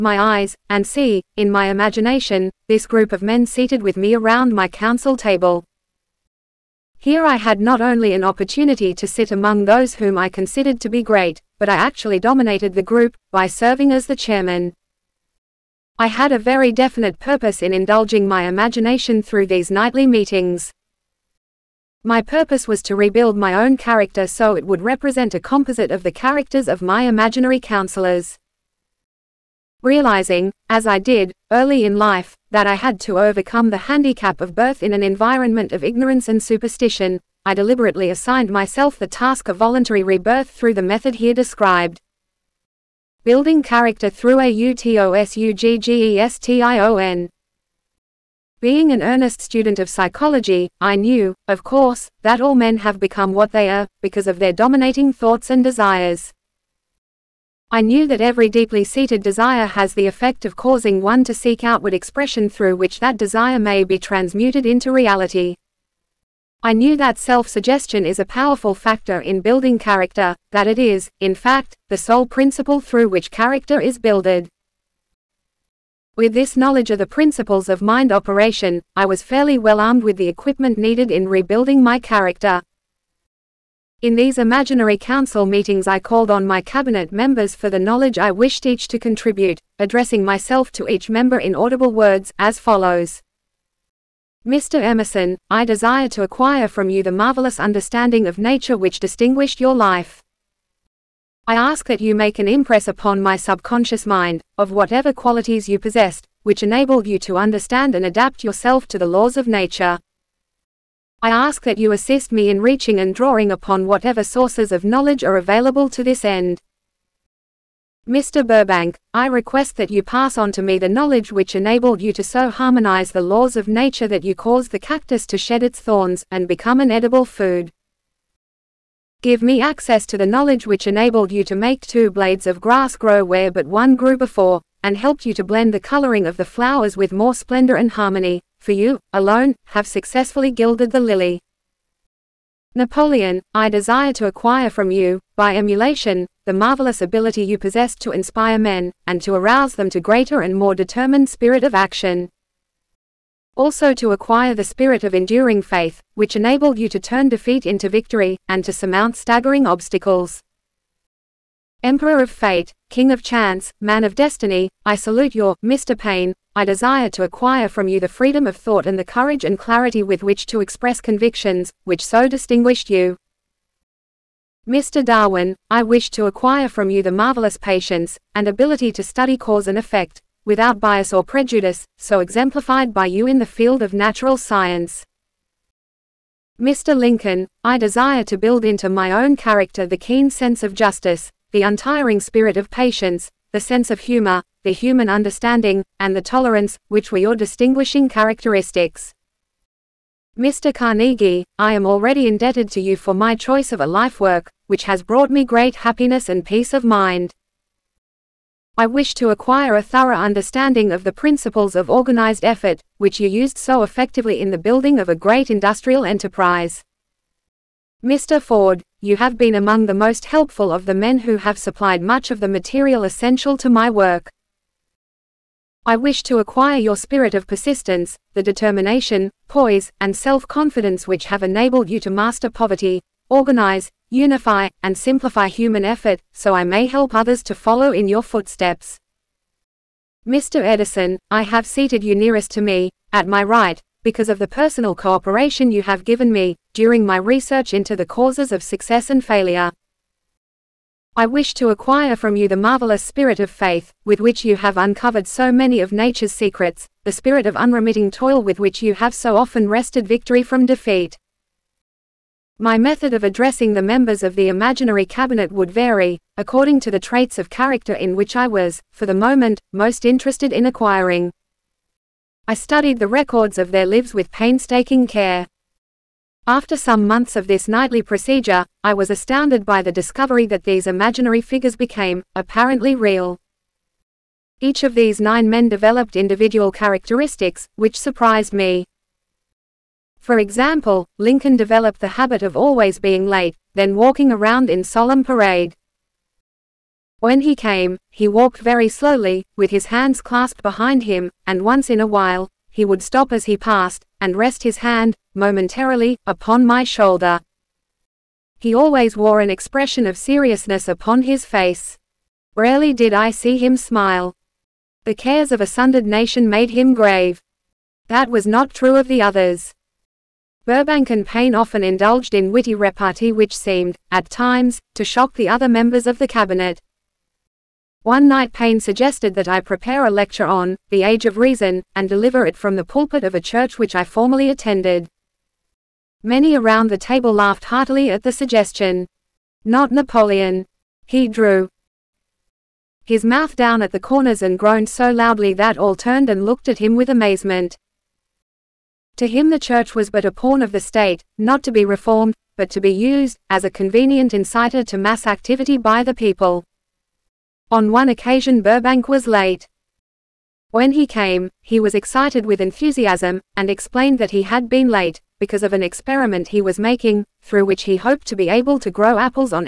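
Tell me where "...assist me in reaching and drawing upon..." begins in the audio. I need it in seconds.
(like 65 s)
111 s.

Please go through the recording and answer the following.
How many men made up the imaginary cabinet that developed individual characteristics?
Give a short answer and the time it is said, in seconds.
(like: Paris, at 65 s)
9, at 285 s.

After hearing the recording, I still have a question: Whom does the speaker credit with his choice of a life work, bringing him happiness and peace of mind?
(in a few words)
Mr. Carnegie.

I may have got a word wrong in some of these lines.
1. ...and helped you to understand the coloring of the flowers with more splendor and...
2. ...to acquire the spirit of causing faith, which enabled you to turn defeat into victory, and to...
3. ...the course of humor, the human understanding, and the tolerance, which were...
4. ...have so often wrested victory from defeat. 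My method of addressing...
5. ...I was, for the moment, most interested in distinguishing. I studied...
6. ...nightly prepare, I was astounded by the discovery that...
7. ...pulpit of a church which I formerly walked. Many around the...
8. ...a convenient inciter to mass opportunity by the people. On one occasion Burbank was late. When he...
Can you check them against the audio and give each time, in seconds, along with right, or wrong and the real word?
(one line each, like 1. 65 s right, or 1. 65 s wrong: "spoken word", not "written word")
1. 134 s wrong: "blend", not "understand"
2. 153 s wrong: "enduring", not "causing"
3. 193 s wrong: "sense", not "course"
4. 258 s right
5. 268 s wrong: "acquiring", not "distinguishing"
6. 277 s wrong: "procedure", not "prepare"
7. 332 s wrong: "attended", not "walked"
8. 353 s wrong: "activity", not "opportunity".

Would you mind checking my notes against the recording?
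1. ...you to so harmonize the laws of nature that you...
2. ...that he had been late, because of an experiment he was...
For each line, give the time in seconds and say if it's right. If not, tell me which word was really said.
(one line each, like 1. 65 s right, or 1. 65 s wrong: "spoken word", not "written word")
1. 122 s right
2. 364 s right.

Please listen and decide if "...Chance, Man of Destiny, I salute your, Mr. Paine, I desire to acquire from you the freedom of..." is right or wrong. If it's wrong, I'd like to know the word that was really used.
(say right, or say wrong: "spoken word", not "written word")
right.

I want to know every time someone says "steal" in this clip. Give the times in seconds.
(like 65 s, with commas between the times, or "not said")
not said.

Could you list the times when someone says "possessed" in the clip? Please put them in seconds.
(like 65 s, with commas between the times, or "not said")
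105 s, 147 s.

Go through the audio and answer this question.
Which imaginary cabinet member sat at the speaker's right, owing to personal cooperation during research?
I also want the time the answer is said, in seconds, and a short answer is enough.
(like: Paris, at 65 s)
Mr. Edison, at 240 s.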